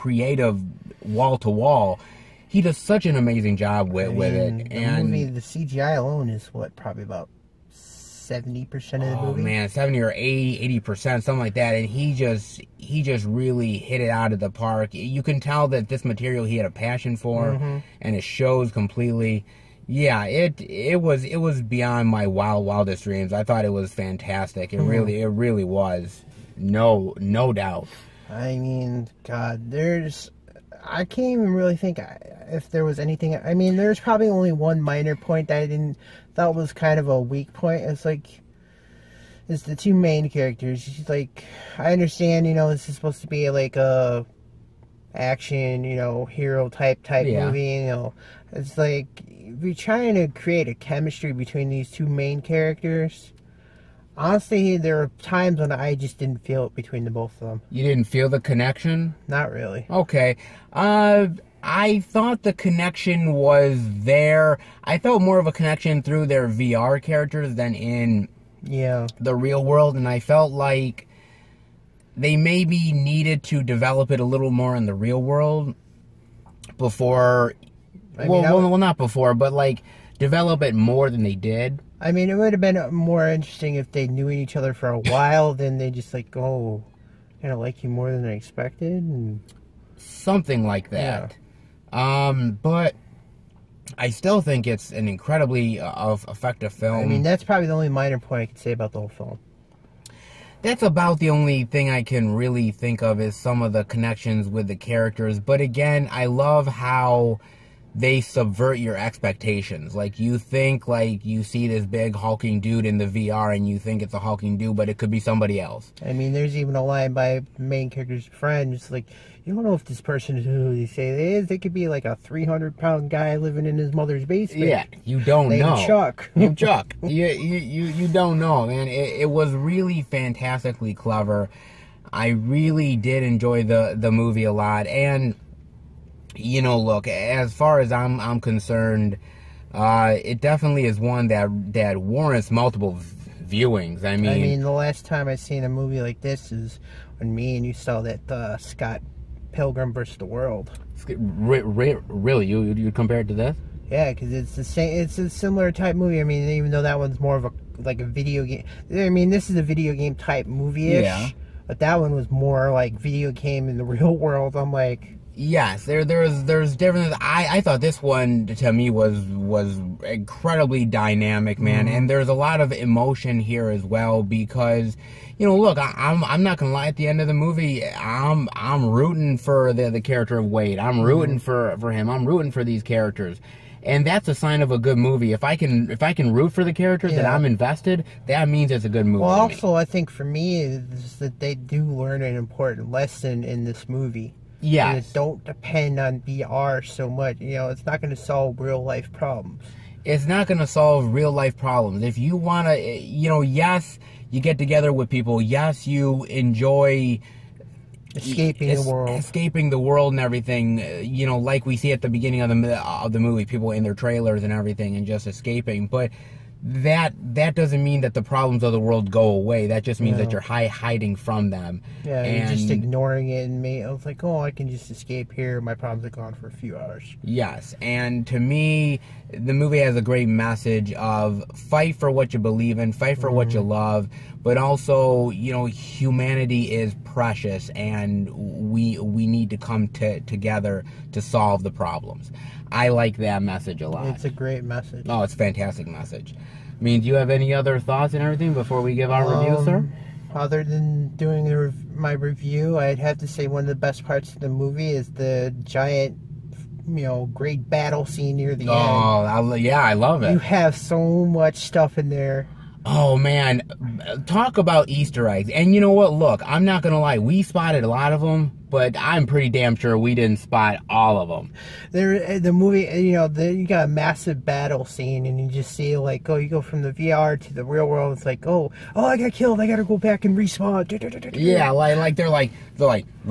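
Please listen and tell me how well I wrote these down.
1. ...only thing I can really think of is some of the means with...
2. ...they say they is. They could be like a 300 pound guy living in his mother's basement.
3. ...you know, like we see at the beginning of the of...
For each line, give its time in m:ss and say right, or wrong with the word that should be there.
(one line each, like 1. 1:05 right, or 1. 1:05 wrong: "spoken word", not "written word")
1. 1:41 wrong: "connections", not "means"
2. 2:00 right
3. 3:31 right.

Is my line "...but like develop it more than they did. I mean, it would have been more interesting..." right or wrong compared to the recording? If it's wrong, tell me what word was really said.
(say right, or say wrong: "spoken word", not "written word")
right.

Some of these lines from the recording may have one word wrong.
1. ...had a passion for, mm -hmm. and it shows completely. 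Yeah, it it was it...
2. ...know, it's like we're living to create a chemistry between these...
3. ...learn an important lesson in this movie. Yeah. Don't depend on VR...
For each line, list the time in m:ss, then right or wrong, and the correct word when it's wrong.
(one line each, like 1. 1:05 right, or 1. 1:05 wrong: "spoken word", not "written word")
1. 0:16 right
2. 0:47 wrong: "trying", not "living"
3. 3:11 right.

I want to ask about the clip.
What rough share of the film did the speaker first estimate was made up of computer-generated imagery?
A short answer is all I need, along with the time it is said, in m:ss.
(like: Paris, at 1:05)
70 percent, at 0:07.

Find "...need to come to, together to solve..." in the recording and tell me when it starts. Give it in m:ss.
3:59.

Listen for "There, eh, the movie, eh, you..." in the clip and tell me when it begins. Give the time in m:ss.
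4:31.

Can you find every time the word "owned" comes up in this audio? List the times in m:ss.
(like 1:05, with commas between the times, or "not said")
not said.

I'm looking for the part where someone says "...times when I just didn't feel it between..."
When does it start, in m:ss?
0:55.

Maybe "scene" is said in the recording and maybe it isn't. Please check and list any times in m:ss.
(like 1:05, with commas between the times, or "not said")
4:18, 4:34.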